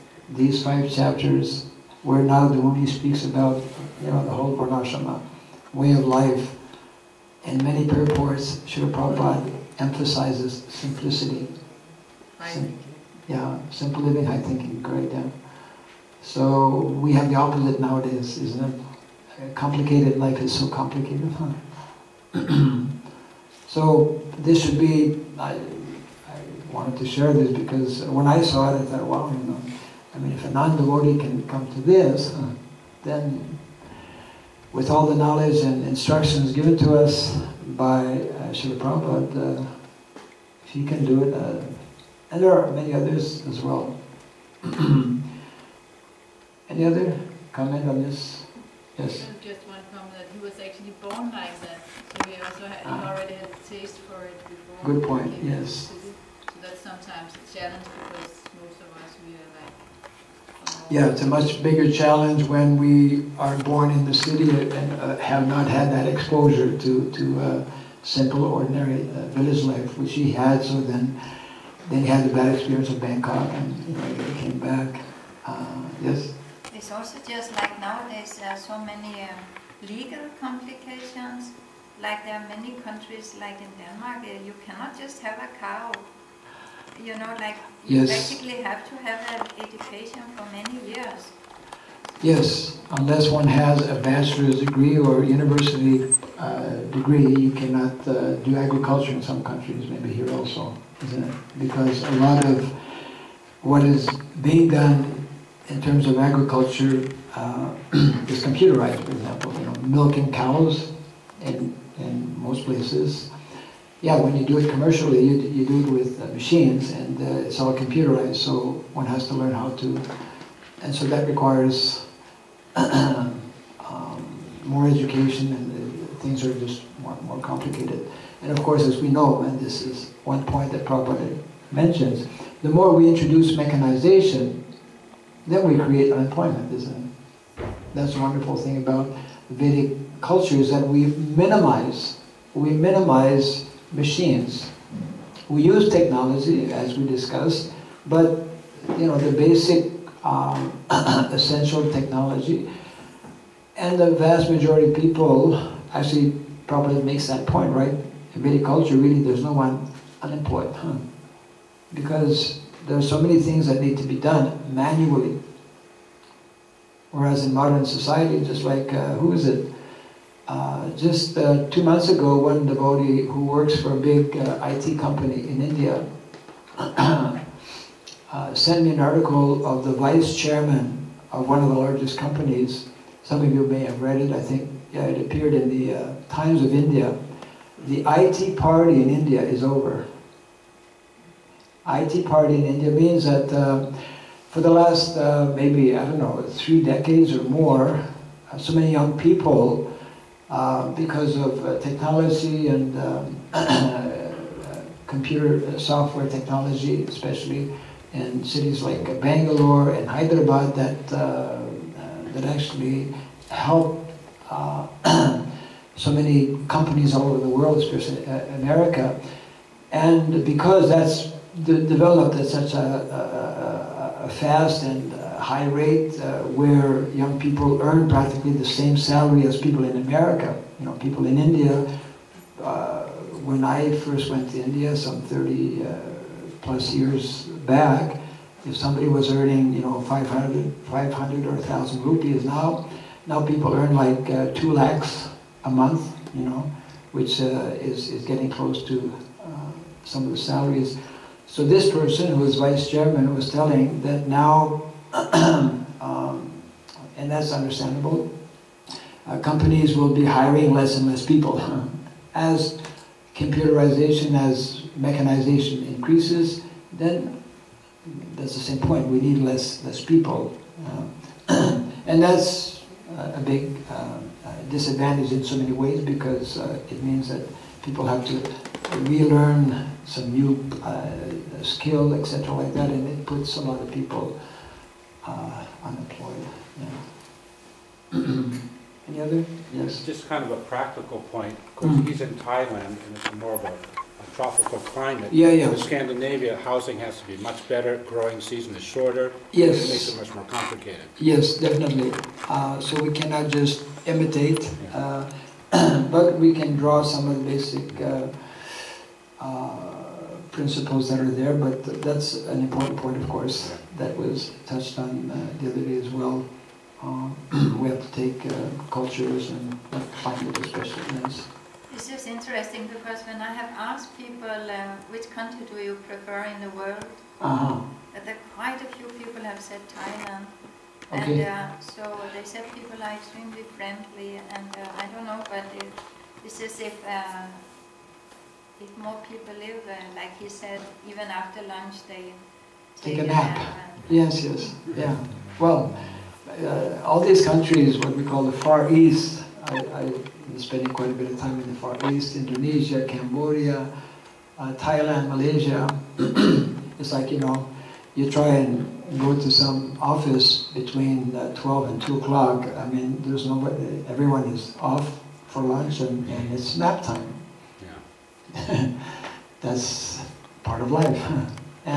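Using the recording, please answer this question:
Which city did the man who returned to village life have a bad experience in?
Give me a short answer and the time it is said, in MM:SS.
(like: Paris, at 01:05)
Bangkok, at 01:12.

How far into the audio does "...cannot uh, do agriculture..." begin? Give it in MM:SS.
01:37.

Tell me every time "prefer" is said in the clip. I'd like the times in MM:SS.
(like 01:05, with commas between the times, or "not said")
05:26.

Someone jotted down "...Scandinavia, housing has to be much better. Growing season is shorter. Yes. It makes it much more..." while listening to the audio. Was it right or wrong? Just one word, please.
right.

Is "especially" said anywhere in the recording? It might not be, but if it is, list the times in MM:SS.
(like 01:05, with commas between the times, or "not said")
03:27, 03:37, 05:20.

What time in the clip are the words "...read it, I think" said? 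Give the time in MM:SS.
03:04.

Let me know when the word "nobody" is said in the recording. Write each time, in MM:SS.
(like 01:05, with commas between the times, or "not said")
06:03.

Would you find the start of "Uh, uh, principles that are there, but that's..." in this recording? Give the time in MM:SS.
05:07.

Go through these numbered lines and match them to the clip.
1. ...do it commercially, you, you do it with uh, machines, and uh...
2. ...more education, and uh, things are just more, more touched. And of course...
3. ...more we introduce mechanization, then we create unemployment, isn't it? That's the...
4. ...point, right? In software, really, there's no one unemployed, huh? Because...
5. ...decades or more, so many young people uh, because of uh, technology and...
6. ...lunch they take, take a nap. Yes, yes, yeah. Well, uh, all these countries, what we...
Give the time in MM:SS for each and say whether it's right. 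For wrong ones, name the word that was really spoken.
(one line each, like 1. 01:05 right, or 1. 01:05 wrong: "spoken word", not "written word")
1. 01:54 right
2. 02:04 wrong: "complicated", not "touched"
3. 02:12 right
4. 02:37 wrong: "culture", not "software"
5. 03:16 right
6. 05:41 right.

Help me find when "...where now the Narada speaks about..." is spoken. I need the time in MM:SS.
00:02.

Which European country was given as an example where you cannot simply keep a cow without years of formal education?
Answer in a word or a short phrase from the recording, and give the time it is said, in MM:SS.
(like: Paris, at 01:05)
Denmark, at 01:23.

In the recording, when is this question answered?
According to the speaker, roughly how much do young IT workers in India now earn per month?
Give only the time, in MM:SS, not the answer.
04:04.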